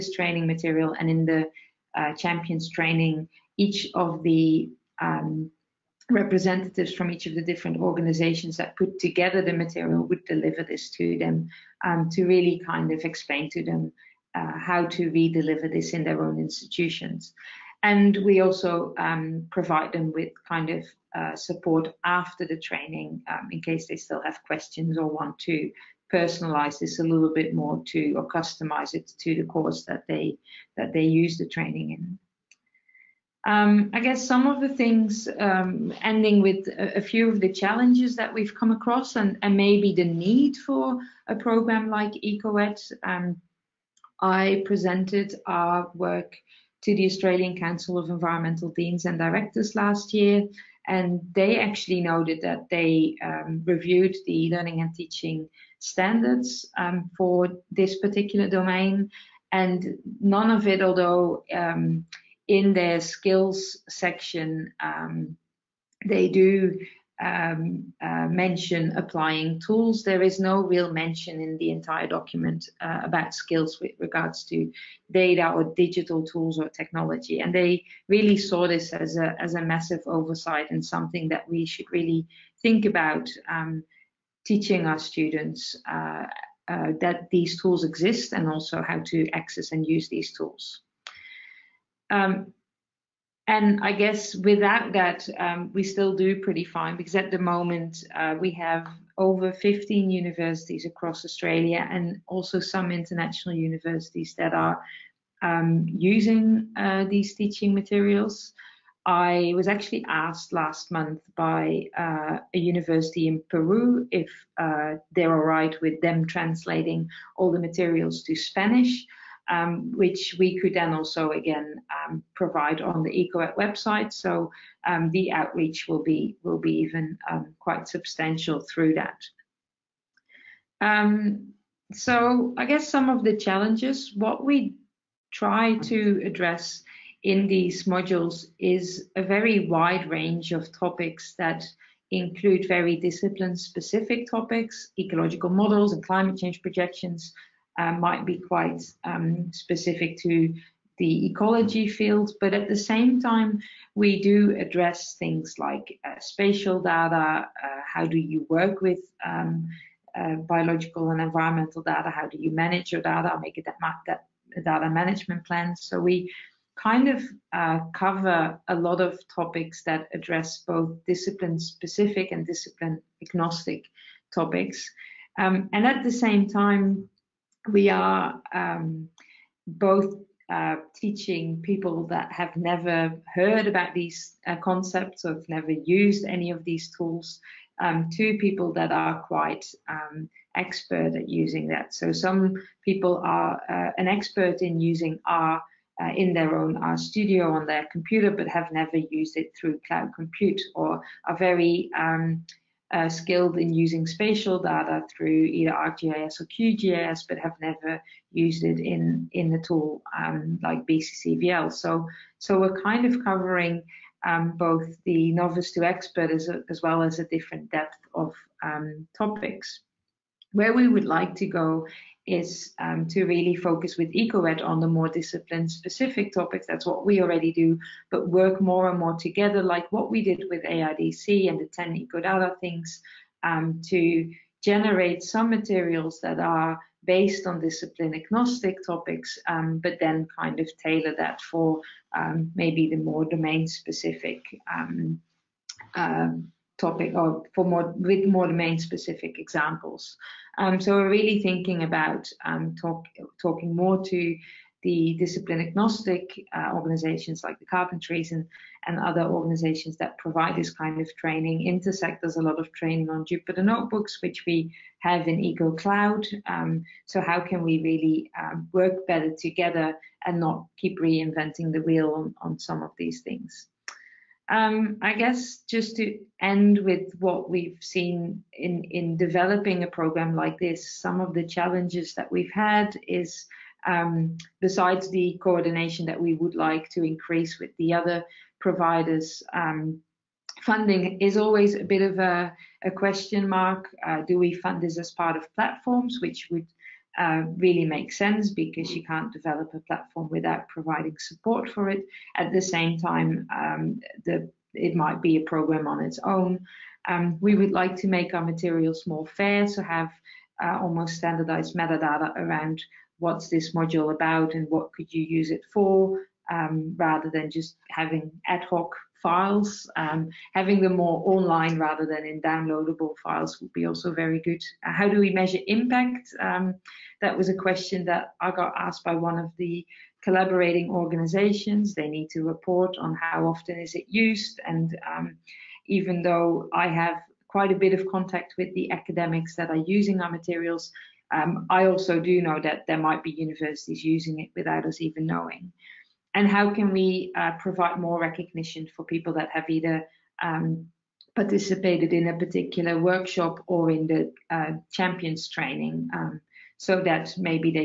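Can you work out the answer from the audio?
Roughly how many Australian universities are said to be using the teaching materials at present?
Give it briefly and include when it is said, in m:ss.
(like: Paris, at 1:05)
over 15, at 1:39.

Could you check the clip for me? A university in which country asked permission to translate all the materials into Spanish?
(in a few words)
Peru.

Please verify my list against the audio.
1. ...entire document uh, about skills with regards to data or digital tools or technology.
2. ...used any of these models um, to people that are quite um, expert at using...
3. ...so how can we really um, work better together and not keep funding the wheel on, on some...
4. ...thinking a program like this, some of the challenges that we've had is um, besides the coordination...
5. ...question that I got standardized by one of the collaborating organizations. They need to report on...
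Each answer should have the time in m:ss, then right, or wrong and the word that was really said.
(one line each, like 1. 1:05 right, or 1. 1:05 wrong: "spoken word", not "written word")
1. 1:11 right
2. 3:05 wrong: "tools", not "models"
3. 4:27 wrong: "reinventing", not "funding"
4. 4:39 wrong: "developing", not "thinking"
5. 5:27 wrong: "asked", not "standardized".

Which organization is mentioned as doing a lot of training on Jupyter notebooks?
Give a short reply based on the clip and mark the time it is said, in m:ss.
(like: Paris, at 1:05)
Intersect, at 4:21.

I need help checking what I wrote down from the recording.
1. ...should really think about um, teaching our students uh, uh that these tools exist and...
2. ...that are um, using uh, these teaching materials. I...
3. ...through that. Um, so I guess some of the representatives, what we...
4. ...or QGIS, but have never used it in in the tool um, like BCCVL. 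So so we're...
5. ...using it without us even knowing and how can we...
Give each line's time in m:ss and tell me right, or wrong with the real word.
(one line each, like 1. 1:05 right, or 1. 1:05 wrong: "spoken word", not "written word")
1. 1:21 right
2. 1:44 right
3. 2:08 wrong: "challenges", not "representatives"
4. 3:26 right
5. 5:44 right.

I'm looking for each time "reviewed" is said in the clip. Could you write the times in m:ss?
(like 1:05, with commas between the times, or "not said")
0:53.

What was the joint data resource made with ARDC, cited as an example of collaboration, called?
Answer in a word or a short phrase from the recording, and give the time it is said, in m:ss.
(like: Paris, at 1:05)
10 EcoData things, at 3:51.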